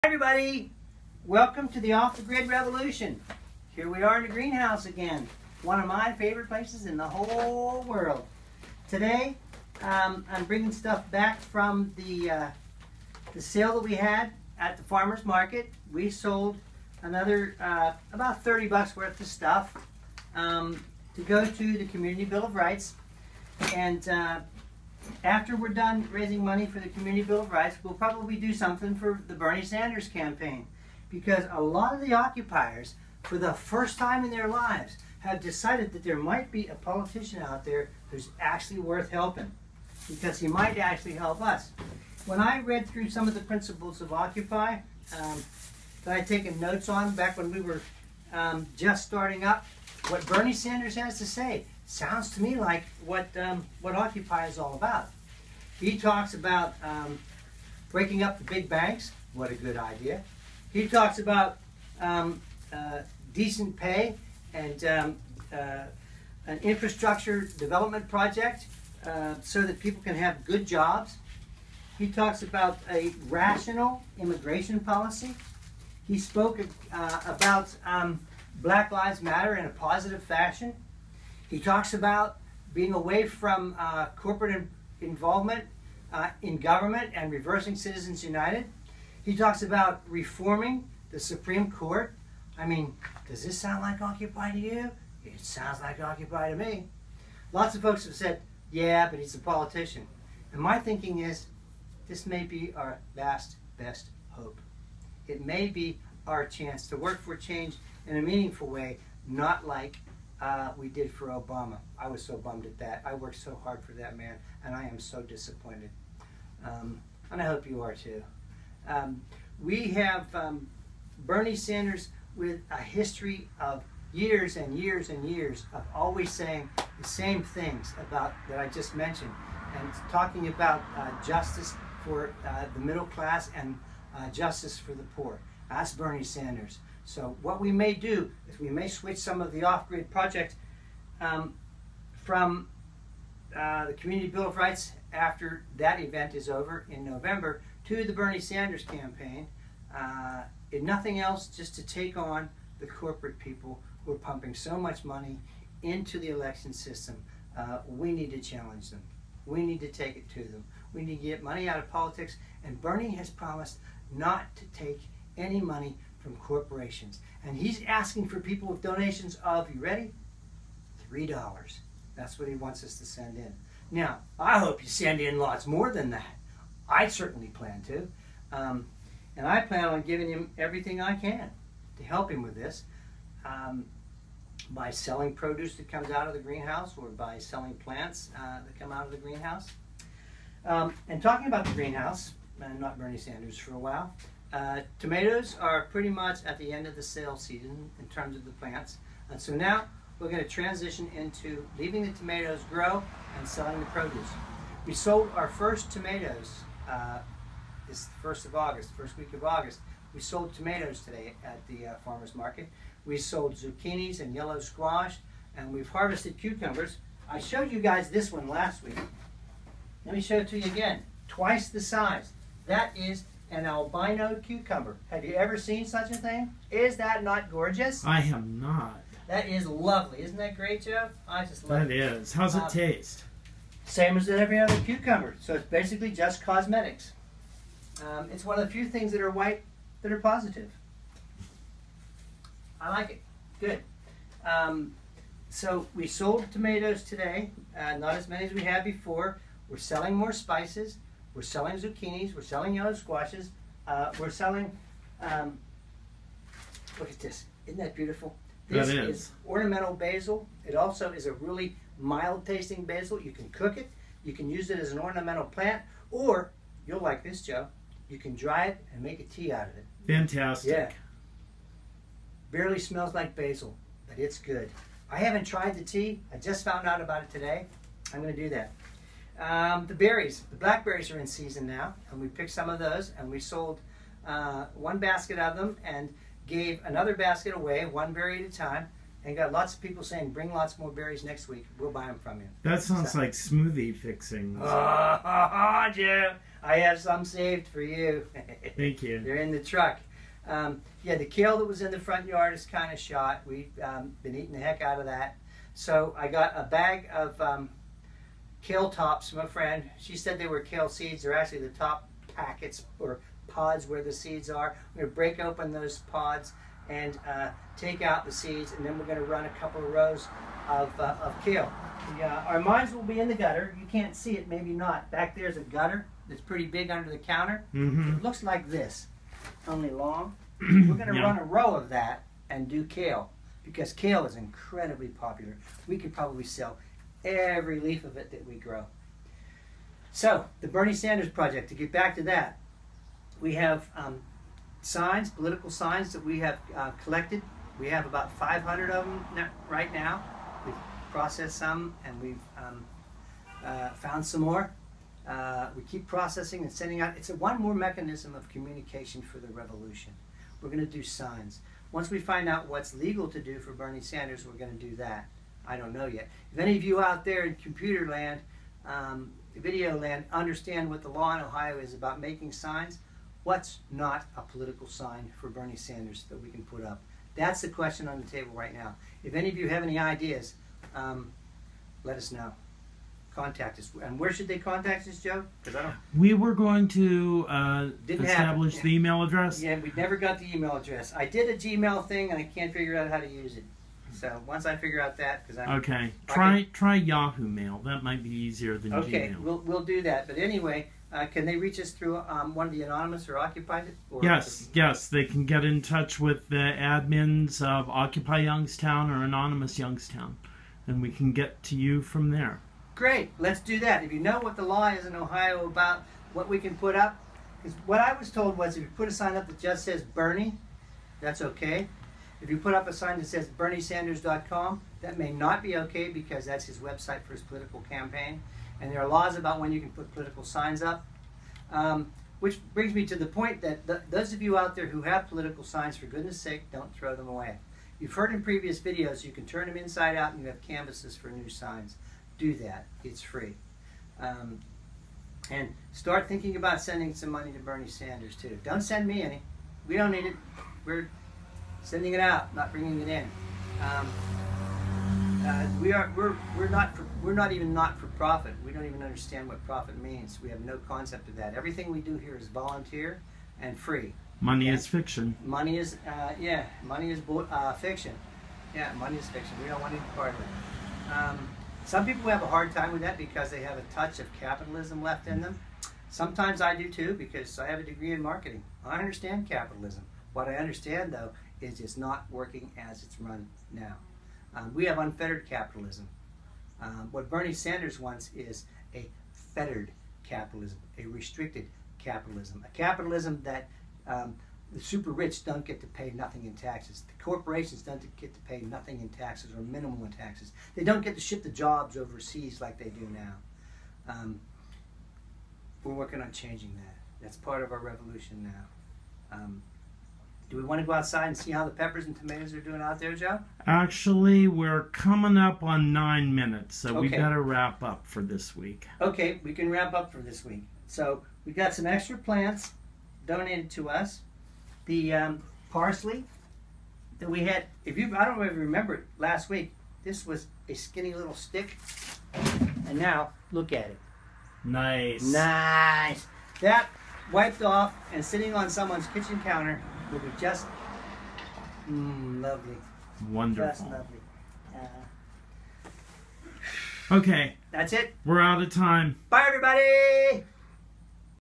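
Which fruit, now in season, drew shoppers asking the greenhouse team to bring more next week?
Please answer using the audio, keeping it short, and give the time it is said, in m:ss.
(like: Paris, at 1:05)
Blackberries, at 4:40.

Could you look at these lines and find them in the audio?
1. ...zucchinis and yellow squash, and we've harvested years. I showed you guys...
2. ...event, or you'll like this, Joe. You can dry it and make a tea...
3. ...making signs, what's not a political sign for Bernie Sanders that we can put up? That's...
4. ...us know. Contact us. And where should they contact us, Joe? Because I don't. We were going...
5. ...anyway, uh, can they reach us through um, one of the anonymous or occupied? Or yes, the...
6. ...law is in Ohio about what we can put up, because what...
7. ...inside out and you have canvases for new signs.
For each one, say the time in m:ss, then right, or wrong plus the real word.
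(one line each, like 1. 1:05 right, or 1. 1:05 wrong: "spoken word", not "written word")
1. 3:33 wrong: "cucumbers", not "years"
2. 4:25 wrong: "plant", not "event"
3. 6:12 right
4. 6:22 right
5. 6:40 right
6. 6:54 right
7. 7:19 right.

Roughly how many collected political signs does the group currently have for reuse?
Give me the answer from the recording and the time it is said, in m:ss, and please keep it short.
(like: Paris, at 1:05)
500, at 5:48.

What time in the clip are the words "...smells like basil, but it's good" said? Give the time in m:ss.
4:32.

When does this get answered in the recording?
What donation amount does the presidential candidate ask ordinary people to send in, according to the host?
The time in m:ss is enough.
2:51.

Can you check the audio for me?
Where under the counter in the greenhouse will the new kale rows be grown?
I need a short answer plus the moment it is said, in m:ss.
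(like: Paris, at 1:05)
The gutter, at 5:23.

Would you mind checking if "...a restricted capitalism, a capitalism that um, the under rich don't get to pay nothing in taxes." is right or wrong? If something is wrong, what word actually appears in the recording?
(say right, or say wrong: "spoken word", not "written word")
wrong: "super", not "under".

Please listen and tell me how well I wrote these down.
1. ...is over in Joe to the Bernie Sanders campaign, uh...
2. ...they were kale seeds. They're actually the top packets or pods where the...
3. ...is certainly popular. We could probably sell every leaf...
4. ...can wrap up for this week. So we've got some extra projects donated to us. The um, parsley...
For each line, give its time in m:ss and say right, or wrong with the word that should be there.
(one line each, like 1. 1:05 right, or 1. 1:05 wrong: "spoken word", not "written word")
1. 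2:26 wrong: "November", not "Joe"
2. 5:10 right
3. 5:34 wrong: "incredibly", not "certainly"
4. 8:39 wrong: "plants", not "projects".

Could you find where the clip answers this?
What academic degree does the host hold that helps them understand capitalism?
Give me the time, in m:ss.
7:57.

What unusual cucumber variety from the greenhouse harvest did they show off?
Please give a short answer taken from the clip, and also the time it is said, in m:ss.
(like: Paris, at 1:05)
Albino, at 3:43.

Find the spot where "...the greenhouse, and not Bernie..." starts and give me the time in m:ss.
3:11.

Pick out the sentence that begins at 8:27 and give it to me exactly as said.
That's part of our revolution now.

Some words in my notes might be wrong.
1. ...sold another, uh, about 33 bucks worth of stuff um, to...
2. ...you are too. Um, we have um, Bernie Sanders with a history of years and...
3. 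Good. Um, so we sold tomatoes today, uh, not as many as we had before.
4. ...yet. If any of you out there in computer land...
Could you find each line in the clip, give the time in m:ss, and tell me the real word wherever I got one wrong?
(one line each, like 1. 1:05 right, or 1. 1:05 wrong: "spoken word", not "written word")
1. 0:16 wrong: "30", not "33"
2. 1:57 right
3. 4:03 right
4. 6:06 right.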